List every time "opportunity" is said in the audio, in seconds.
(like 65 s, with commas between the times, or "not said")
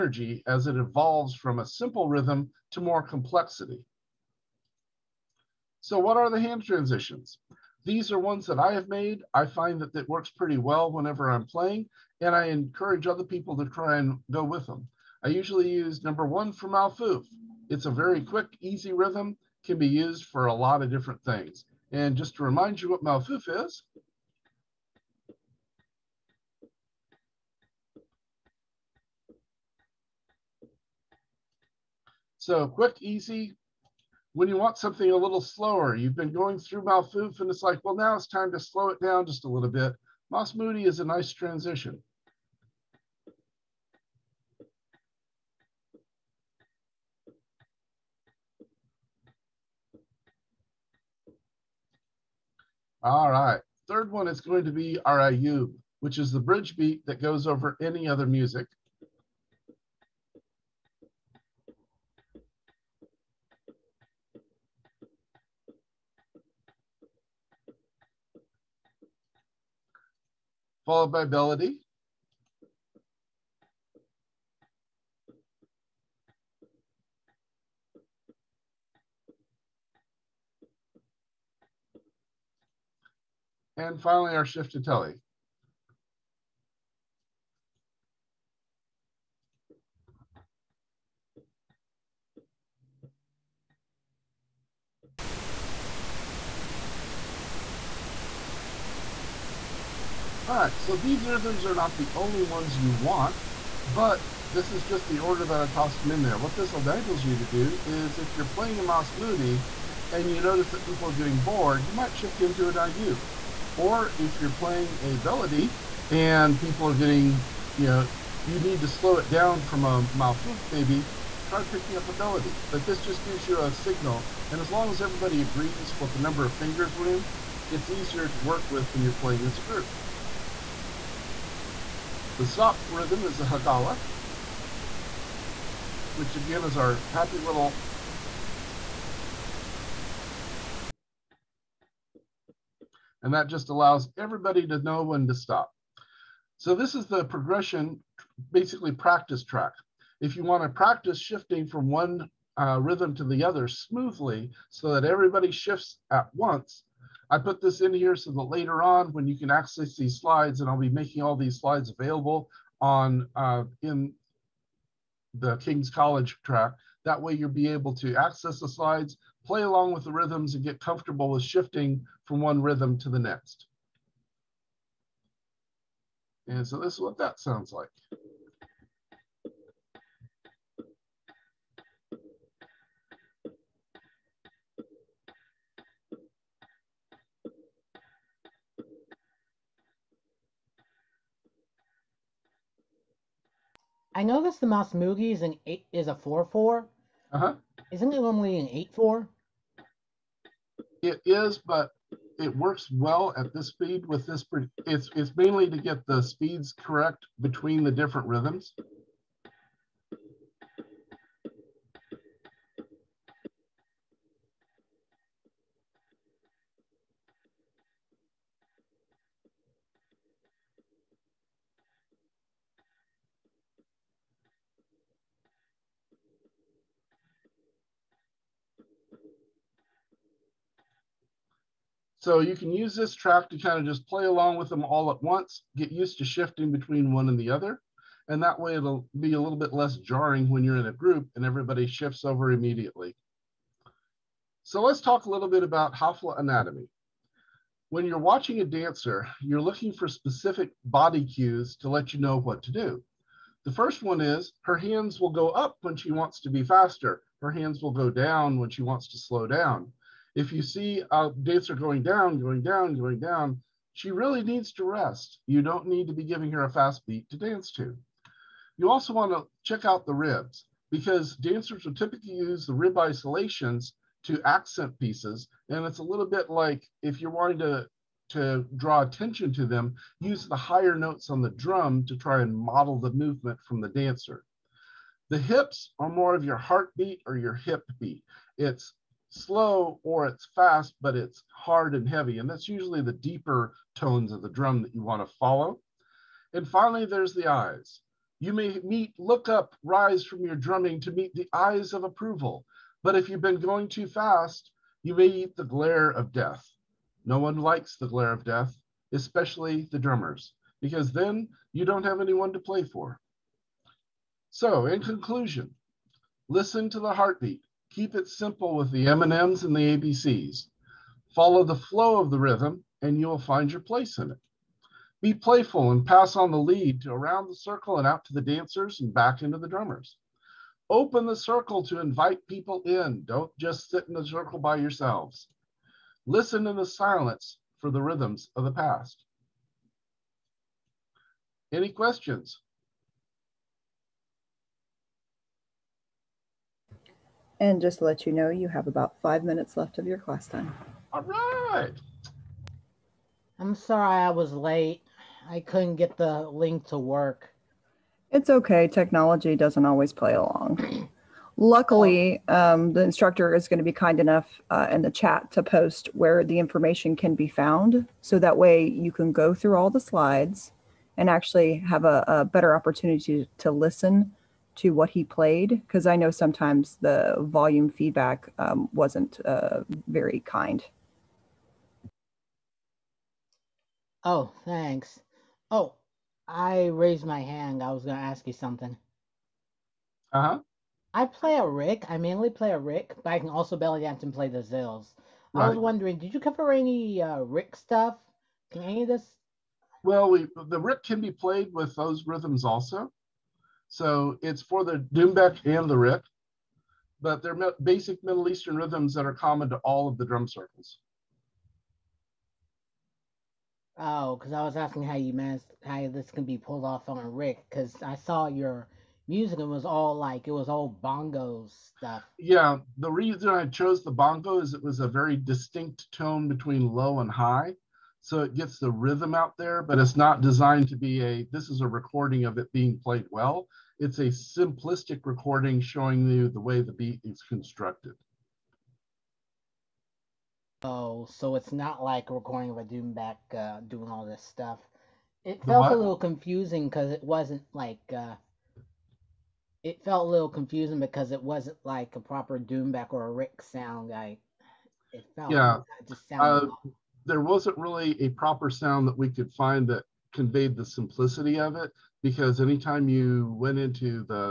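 372 s.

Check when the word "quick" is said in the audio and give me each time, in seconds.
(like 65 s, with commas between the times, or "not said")
18 s, 32 s.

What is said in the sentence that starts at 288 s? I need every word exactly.
It's slow or it's fast, but it's hard and heavy.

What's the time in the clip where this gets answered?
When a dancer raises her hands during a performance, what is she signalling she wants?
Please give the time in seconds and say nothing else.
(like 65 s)
256 s.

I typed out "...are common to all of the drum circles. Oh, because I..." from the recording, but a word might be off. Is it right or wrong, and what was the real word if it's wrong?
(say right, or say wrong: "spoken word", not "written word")
right.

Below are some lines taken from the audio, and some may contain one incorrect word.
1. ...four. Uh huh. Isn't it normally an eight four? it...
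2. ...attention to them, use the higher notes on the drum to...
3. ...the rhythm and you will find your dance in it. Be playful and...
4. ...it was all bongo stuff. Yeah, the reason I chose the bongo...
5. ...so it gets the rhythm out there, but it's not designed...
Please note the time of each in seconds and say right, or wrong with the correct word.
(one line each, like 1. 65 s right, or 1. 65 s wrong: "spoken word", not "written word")
1. 196 s right
2. 279 s right
3. 322 s wrong: "place", not "dance"
4. 420 s right
5. 428 s right.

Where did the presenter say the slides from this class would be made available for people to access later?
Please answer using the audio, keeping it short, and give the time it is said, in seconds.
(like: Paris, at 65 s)
King's College track, at 165 s.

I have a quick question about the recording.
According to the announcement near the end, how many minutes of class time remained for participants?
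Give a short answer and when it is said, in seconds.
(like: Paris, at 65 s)
5, at 349 s.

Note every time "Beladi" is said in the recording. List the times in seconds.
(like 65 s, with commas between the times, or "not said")
71 s, 115 s, 122 s.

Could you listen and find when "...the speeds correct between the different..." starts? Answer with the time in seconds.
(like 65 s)
206 s.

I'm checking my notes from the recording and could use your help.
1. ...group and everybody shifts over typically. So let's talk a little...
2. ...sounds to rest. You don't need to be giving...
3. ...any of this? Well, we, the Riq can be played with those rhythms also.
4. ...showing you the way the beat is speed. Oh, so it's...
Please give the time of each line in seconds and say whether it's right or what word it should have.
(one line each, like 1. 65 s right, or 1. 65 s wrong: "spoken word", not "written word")
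1. 240 s wrong: "immediately", not "typically"
2. 264 s wrong: "needs", not "sounds"
3. 398 s right
4. 435 s wrong: "constructed", not "speed".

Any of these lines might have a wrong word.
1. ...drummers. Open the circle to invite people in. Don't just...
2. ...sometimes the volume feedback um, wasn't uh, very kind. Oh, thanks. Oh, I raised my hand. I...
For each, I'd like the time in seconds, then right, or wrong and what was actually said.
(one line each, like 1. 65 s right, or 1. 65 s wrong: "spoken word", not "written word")
1. 329 s right
2. 376 s right.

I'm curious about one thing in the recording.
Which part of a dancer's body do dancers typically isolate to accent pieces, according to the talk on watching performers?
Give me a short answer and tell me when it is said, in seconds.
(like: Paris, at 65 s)
Ribs, at 270 s.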